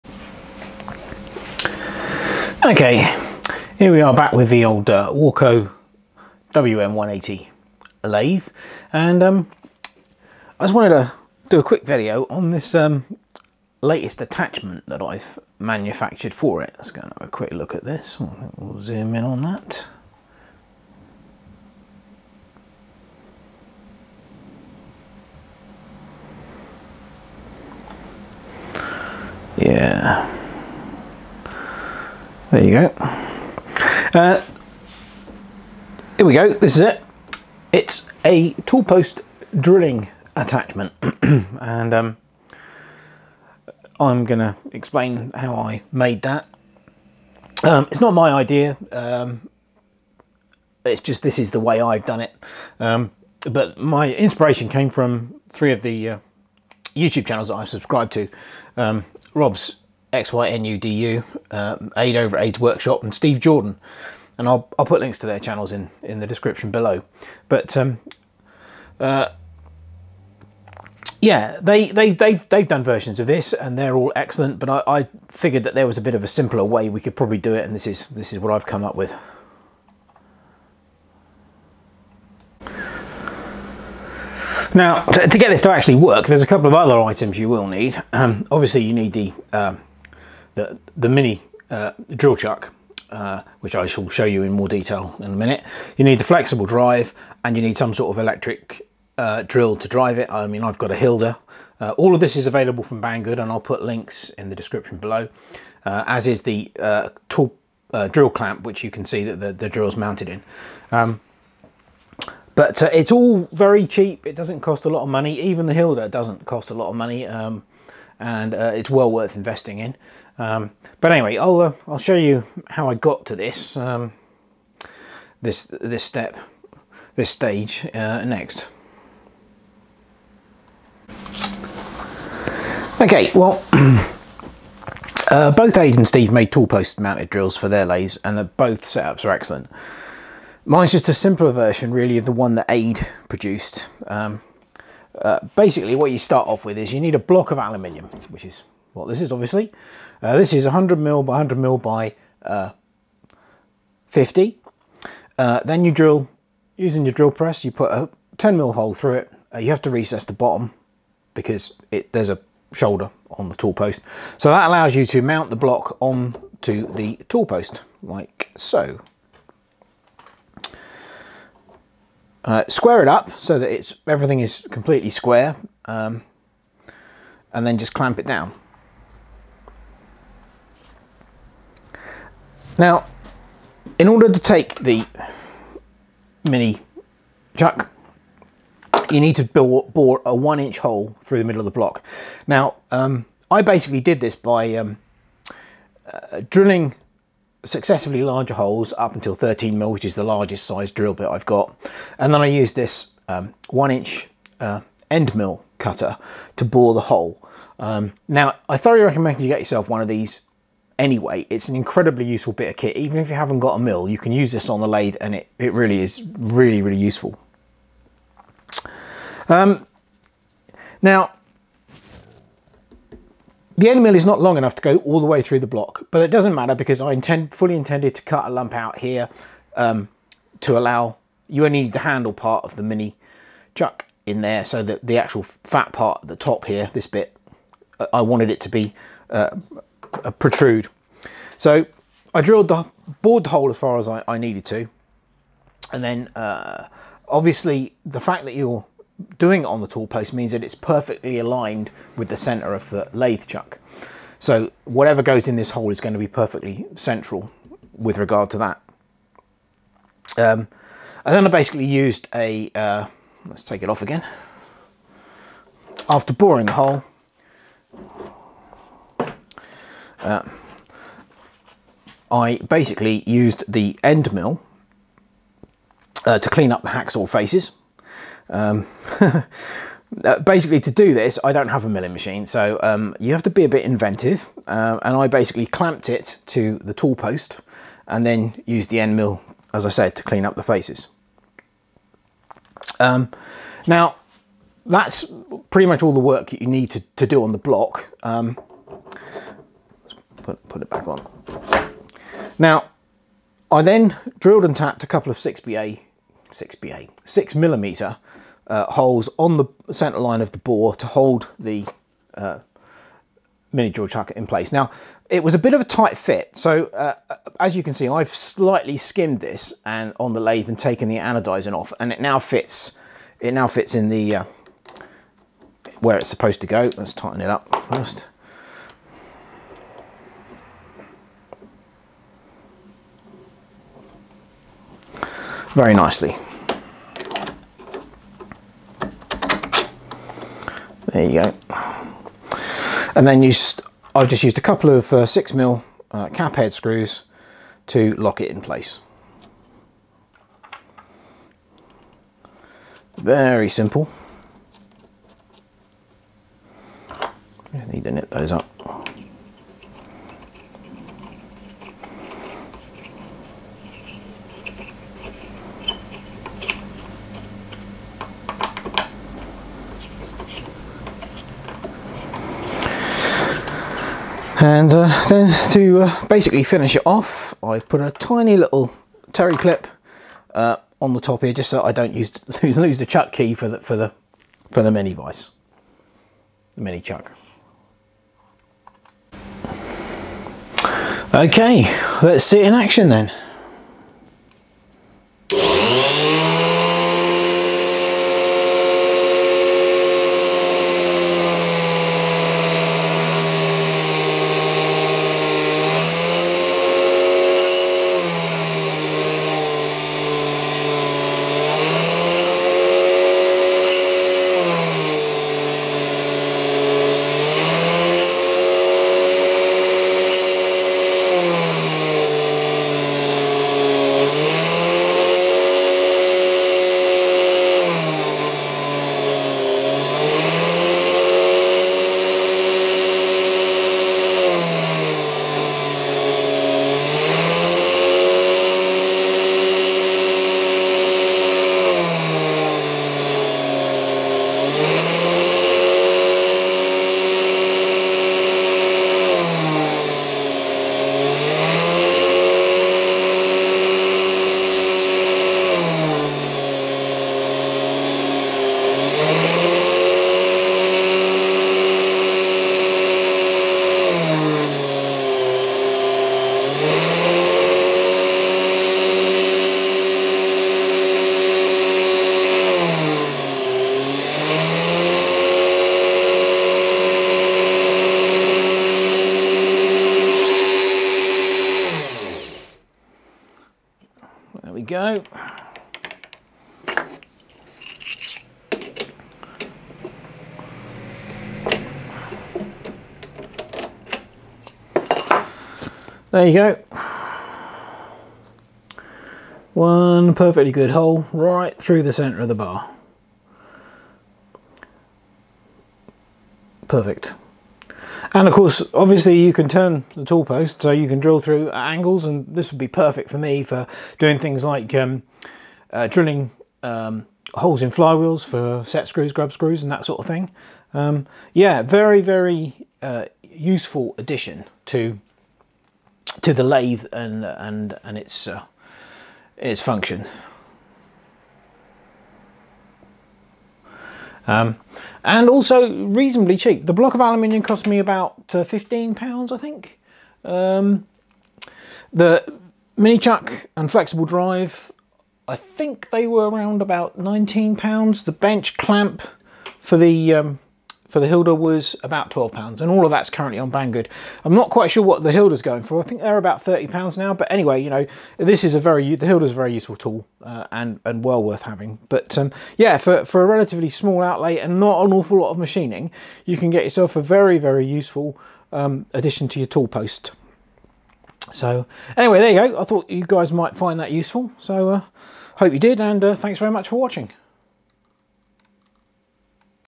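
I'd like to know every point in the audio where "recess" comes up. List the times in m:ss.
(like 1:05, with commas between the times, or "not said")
2:39.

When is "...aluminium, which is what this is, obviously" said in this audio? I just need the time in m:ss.
2:27.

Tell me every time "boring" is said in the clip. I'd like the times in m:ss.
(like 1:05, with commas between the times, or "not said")
4:26.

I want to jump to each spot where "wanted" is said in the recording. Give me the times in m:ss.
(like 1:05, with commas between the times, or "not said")
0:10, 3:58.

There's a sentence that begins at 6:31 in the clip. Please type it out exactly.
Okay, let's see it in action then.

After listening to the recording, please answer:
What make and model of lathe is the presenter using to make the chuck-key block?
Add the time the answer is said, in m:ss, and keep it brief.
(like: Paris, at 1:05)
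Warco WM180, at 0:05.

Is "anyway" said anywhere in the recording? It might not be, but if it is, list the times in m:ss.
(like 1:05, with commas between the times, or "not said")
2:01, 3:30, 9:17, 9:32.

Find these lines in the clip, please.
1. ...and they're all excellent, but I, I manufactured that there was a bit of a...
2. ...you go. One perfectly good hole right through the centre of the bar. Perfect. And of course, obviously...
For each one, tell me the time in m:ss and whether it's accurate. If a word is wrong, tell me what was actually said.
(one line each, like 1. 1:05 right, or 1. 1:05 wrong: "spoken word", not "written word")
1. 1:13 wrong: "figured", not "manufactured"
2. 8:16 right.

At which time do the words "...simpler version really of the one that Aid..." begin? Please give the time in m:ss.
2:21.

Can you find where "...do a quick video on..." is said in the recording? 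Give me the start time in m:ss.
0:11.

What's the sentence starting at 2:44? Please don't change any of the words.
So that allows you to mount the block onto the tool post, like so.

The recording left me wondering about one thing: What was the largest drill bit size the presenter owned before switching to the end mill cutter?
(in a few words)
13 mil.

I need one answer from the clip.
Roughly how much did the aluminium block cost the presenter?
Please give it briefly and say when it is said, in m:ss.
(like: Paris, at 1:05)
15 pounds, at 8:58.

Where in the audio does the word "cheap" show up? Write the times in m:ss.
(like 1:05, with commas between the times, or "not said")
1:53, 8:56.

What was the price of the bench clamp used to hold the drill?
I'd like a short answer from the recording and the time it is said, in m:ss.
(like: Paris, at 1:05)
£12, at 9:12.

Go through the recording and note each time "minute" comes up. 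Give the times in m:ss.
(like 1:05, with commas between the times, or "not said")
1:35.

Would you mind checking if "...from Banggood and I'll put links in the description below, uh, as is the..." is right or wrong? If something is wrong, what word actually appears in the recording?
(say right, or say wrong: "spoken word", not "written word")
right.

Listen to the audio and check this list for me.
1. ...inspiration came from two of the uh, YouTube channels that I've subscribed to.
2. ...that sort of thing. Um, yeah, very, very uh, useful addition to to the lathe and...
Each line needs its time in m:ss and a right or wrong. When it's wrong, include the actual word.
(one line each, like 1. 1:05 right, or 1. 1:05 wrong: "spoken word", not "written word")
1. 0:54 wrong: "three", not "two"
2. 8:39 right.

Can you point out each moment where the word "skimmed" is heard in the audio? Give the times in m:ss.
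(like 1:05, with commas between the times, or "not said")
5:18.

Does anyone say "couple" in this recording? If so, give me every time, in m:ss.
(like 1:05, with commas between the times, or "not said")
1:26, 5:05, 5:44.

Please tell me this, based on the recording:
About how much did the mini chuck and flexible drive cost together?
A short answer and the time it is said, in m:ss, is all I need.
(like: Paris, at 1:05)
19 pounds, at 9:07.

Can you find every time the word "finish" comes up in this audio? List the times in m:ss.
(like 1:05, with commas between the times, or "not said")
6:16.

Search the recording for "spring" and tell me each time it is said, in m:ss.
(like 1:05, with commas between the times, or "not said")
not said.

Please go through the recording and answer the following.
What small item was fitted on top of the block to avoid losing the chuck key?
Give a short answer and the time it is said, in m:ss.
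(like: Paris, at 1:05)
terry clip, at 6:19.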